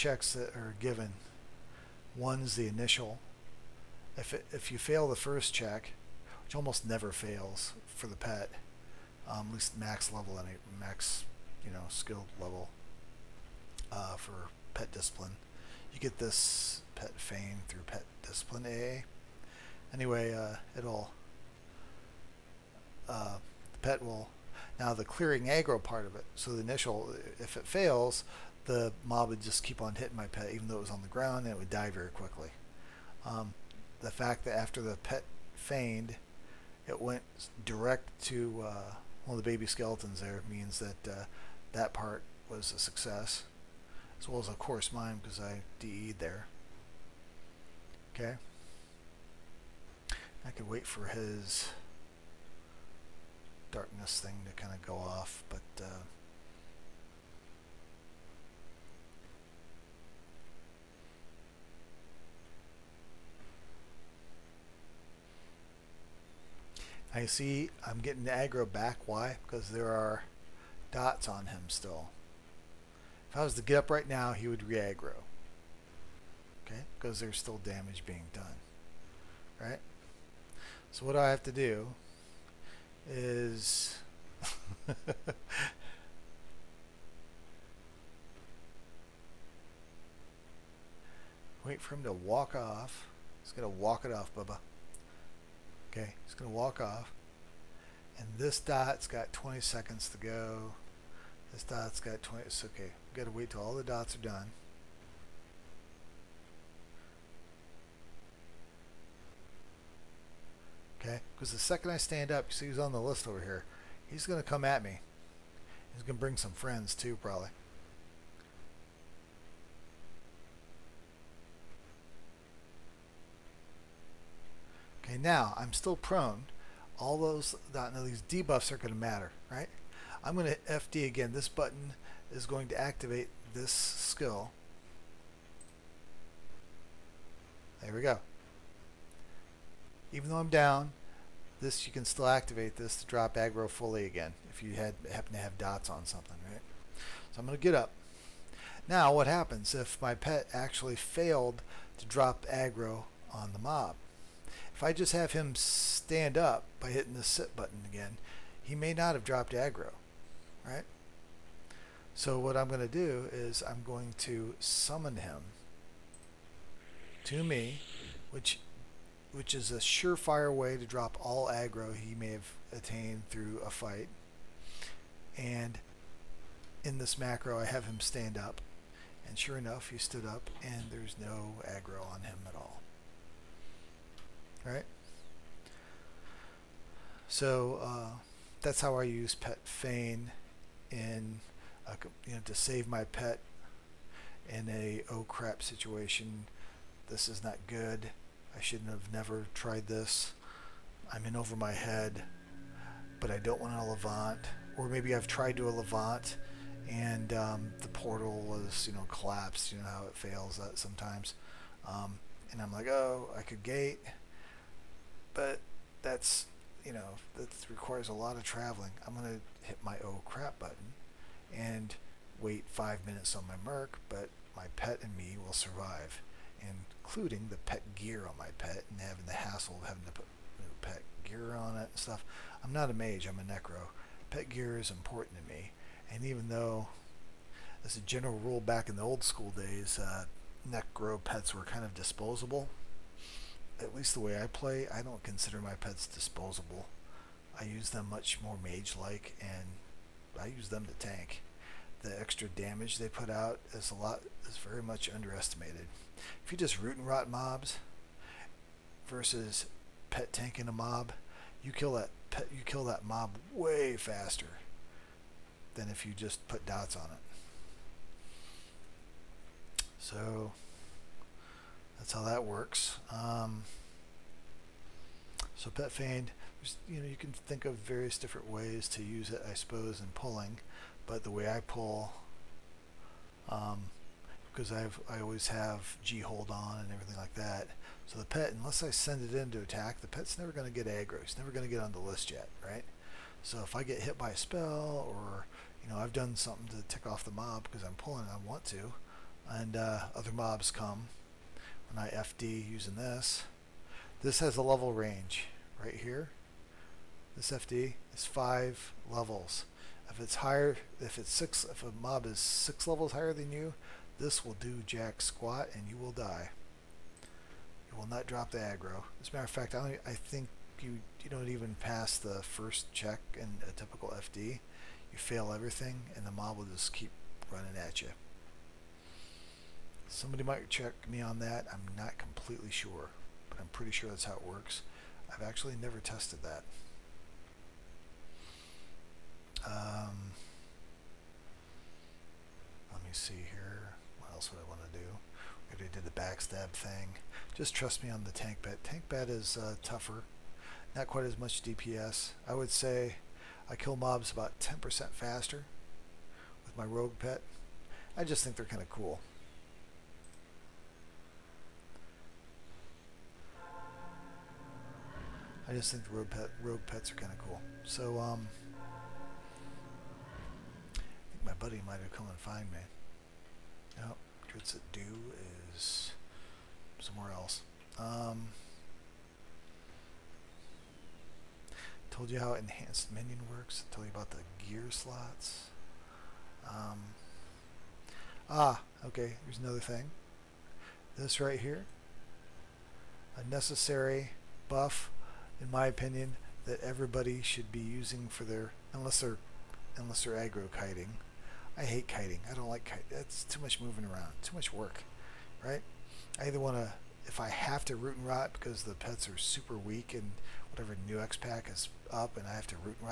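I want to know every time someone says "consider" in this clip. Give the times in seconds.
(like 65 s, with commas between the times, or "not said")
245 s.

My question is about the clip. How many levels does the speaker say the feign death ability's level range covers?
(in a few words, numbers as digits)
5 levels.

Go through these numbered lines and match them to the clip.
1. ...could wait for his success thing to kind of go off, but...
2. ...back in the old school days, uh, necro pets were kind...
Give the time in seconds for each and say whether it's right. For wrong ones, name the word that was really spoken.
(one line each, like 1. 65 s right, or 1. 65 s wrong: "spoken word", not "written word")
1. 50 s wrong: "darkness", not "success"
2. 238 s right.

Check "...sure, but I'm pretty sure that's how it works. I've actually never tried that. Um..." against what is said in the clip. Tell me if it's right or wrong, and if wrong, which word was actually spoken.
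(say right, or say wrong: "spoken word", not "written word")
wrong: "tested", not "tried".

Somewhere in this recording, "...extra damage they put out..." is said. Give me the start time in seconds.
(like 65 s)
252 s.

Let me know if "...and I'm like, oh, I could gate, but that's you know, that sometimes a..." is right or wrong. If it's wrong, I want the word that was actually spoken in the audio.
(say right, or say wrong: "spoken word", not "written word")
wrong: "requires", not "sometimes".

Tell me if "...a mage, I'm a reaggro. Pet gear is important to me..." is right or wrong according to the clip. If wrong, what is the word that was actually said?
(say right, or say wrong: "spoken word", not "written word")
wrong: "necro", not "reaggro".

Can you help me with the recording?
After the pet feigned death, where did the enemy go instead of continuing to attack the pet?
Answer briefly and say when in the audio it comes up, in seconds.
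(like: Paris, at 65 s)
Baby skeletons, at 39 s.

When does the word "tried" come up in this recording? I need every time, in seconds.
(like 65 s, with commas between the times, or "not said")
199 s, 205 s.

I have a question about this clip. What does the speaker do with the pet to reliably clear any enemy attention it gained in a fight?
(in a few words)
Summon him.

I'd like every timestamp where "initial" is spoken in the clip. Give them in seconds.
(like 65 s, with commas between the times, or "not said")
2 s, 26 s.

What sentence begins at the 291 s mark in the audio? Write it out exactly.
It's never going to get on the list yet, right?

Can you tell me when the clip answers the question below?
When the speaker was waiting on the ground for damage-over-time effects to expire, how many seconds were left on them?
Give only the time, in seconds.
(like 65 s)
99 s.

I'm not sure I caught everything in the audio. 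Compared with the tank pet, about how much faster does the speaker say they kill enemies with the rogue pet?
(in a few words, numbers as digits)
10%.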